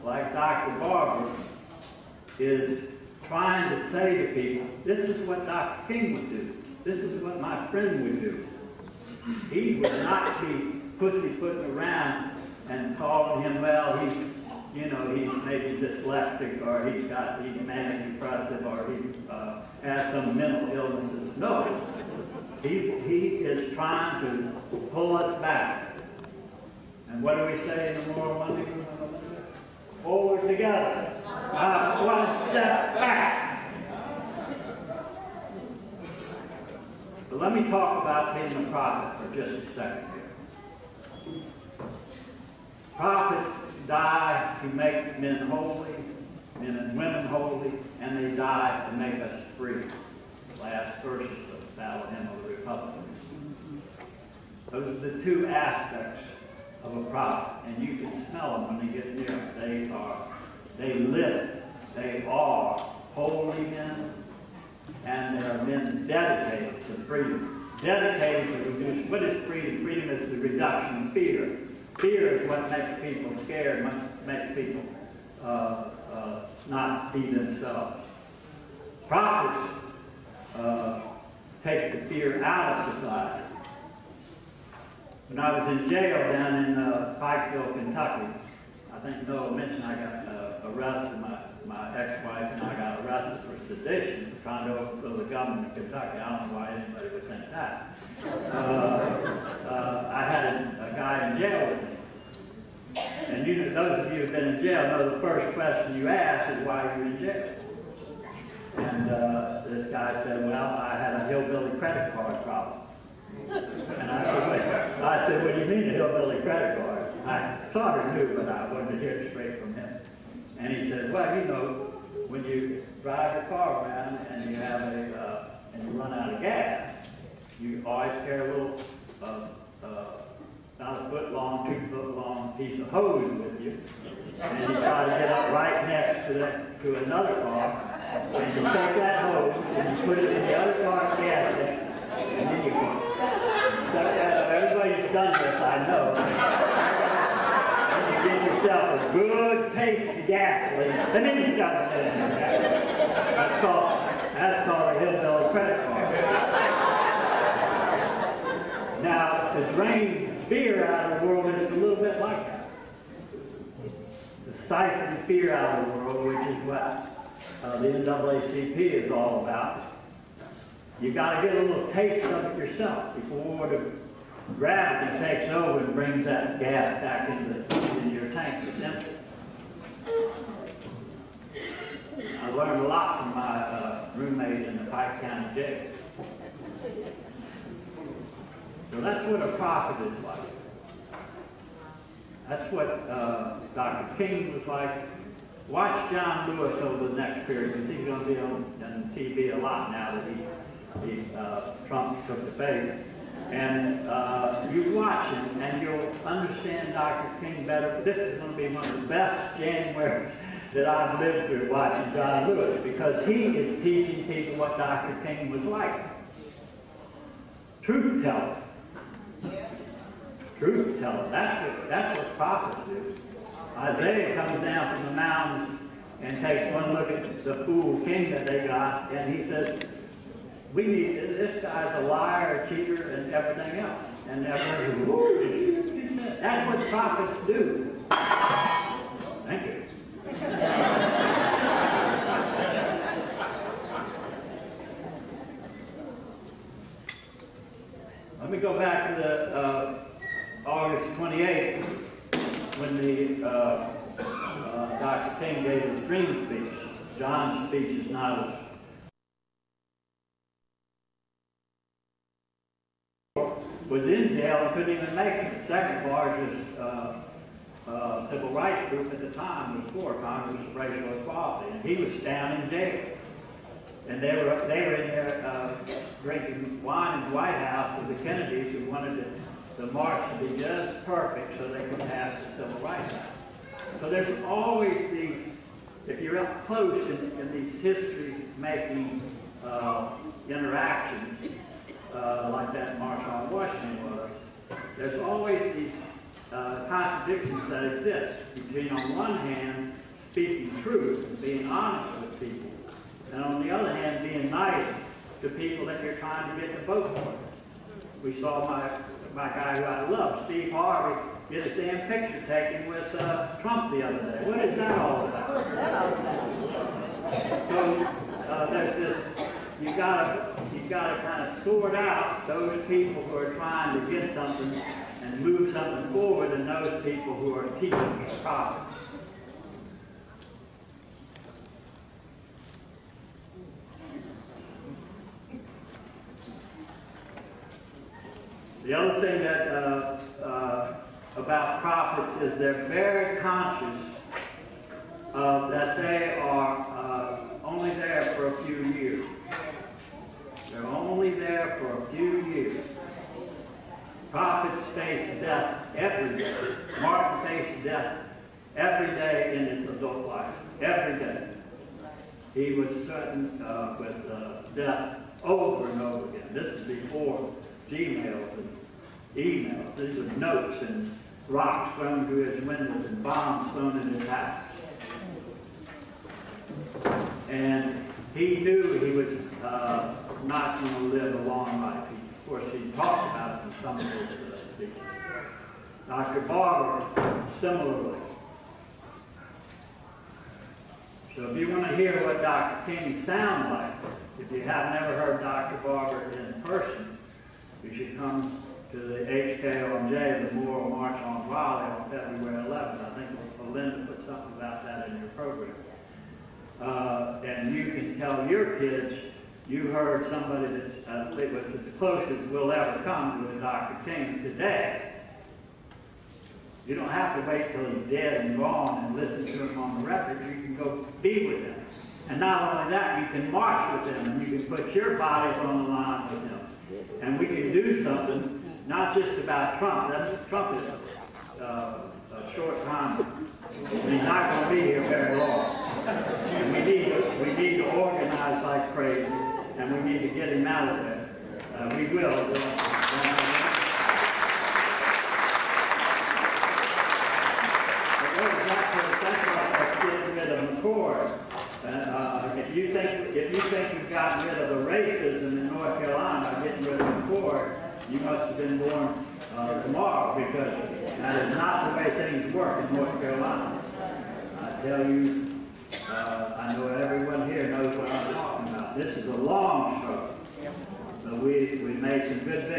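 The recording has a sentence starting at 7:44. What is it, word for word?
I tell you, uh, I know everyone here knows what I'm talking about.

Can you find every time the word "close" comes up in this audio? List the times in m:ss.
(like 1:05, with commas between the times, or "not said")
4:46, 6:51.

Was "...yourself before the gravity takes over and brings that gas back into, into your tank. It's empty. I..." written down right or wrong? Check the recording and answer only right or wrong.
right.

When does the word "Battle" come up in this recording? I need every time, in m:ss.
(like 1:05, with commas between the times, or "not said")
0:51.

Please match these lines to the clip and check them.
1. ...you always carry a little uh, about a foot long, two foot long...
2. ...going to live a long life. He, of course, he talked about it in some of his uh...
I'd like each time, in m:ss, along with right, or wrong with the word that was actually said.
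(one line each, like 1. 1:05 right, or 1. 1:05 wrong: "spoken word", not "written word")
1. 2:07 right
2. 6:20 right.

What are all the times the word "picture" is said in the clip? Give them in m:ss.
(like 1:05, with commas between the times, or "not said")
5:12.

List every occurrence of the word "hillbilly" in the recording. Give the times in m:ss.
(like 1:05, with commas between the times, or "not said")
1:51, 1:55, 2:34.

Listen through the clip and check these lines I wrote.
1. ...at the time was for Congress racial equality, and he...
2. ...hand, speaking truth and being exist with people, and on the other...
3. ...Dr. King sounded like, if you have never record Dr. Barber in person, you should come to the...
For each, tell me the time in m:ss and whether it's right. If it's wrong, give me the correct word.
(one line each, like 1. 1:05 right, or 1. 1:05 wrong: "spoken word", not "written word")
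1. 4:29 right
2. 4:59 wrong: "honest", not "exist"
3. 6:32 wrong: "heard", not "record".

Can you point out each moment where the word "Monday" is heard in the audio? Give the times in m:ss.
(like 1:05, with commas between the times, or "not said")
0:28.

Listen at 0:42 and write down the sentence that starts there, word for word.
Prophets die to make men holy, men and women holy, and they die to make us free.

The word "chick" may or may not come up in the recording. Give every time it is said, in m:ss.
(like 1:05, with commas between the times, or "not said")
not said.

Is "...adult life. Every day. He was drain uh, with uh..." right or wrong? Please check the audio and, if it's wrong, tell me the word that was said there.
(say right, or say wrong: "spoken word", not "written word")
wrong: "certain", not "drain".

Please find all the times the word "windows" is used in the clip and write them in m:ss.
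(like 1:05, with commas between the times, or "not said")
6:12.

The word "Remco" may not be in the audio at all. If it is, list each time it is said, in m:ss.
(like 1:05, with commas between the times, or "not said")
not said.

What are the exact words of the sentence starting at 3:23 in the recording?
And uh, you watch him and you'll understand Dr.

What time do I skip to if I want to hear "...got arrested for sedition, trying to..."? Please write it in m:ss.
1:32.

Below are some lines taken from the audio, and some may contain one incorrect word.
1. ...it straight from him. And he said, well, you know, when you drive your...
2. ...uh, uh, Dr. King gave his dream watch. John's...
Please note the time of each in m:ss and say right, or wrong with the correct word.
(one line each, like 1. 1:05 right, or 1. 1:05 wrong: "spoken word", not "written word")
1. 1:59 right
2. 4:13 wrong: "speech", not "watch".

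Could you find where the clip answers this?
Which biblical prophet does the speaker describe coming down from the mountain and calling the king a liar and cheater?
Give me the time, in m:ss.
3:43.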